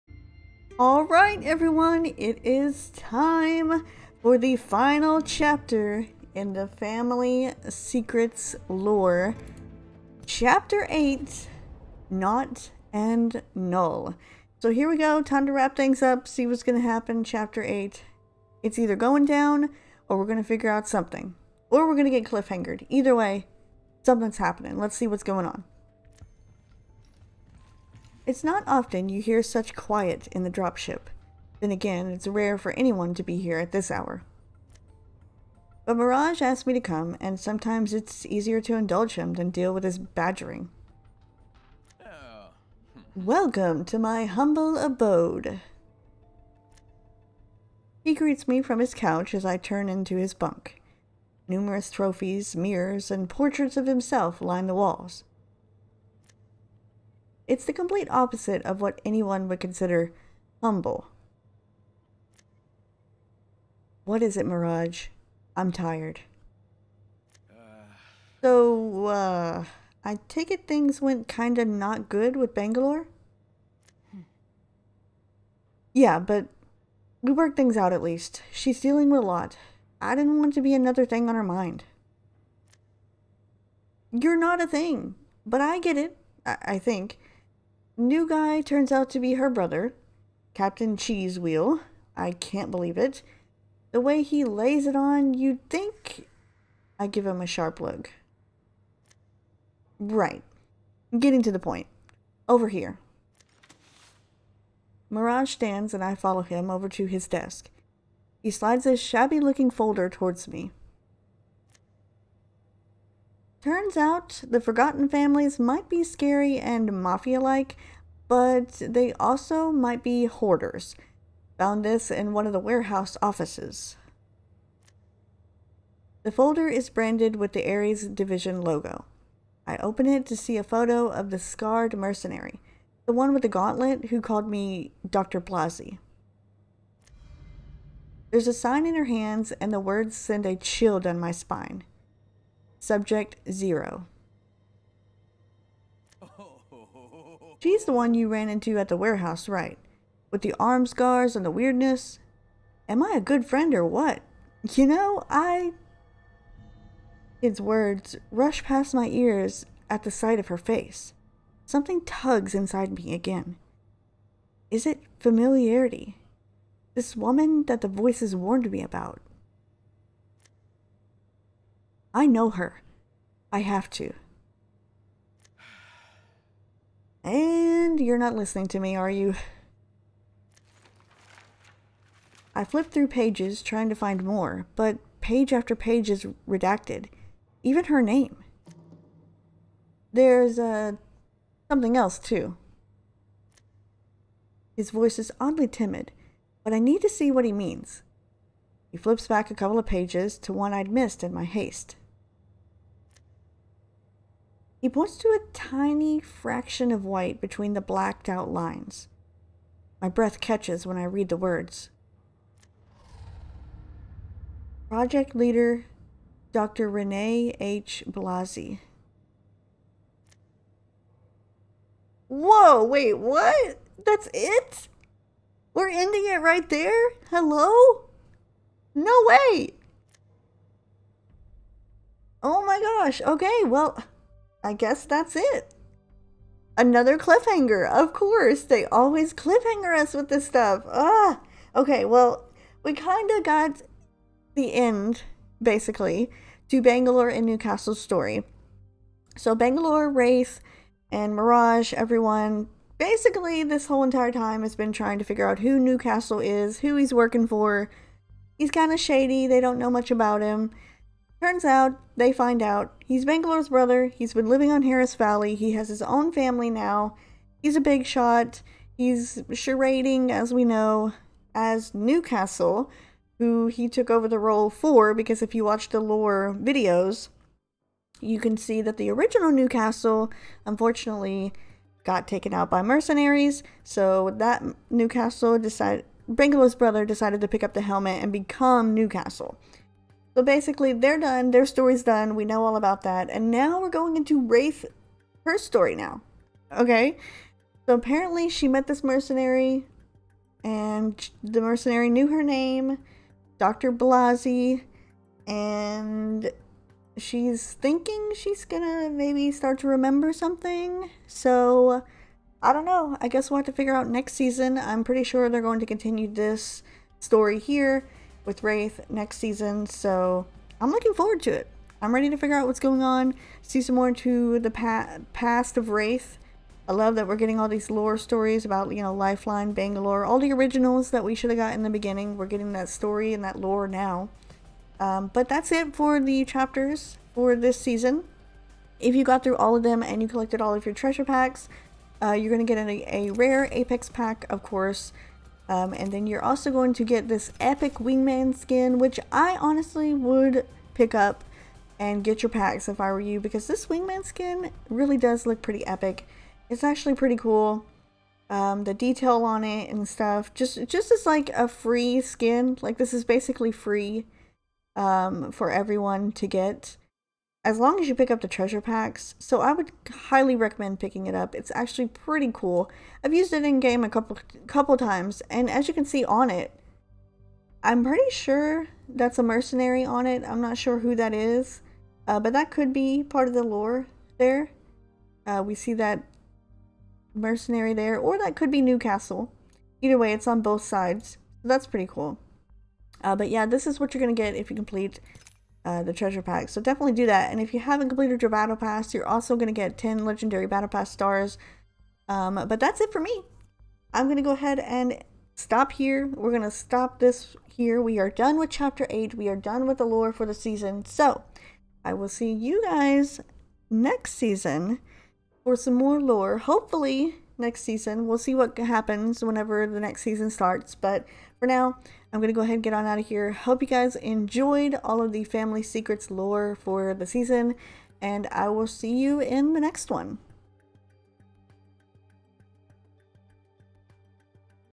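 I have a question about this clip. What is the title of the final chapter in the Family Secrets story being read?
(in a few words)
Nought and Null.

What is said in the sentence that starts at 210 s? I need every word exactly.
My breath catches when I read the words.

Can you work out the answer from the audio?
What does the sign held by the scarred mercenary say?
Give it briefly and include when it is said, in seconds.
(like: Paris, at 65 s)
Subject 0, at 142 s.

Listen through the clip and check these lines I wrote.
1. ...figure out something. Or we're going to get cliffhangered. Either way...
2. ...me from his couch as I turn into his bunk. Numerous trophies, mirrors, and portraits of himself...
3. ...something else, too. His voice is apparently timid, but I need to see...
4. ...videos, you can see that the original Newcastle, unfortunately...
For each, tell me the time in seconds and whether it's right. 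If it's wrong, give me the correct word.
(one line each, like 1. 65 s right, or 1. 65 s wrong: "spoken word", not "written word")
1. 20 s right
2. 48 s right
3. 191 s wrong: "oddly", not "apparently"
4. 276 s right.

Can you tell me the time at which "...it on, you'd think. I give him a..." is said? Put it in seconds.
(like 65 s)
94 s.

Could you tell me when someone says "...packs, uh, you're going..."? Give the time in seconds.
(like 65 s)
341 s.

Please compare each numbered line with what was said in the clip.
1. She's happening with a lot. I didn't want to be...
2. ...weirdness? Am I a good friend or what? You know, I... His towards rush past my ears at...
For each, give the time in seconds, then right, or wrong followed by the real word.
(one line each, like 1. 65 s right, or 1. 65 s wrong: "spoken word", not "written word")
1. 78 s wrong: "dealing", not "happening"
2. 151 s wrong: "words", not "towards".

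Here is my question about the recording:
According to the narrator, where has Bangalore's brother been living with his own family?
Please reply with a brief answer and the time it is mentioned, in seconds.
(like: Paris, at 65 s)
Harris Valley, at 264 s.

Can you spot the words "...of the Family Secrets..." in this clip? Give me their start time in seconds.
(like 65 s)
425 s.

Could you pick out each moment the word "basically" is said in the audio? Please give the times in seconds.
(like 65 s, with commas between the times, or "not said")
245 s, 252 s, 290 s, 363 s.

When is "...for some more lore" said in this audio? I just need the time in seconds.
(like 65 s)
415 s.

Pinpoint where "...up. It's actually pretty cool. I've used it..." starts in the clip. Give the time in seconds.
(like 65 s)
371 s.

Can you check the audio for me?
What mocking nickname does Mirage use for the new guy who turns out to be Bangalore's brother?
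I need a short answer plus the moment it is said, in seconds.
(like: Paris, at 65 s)
Captain Cheese Wheel, at 90 s.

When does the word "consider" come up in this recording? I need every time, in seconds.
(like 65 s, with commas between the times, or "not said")
59 s.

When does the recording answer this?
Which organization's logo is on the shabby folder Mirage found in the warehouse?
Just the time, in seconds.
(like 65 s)
127 s.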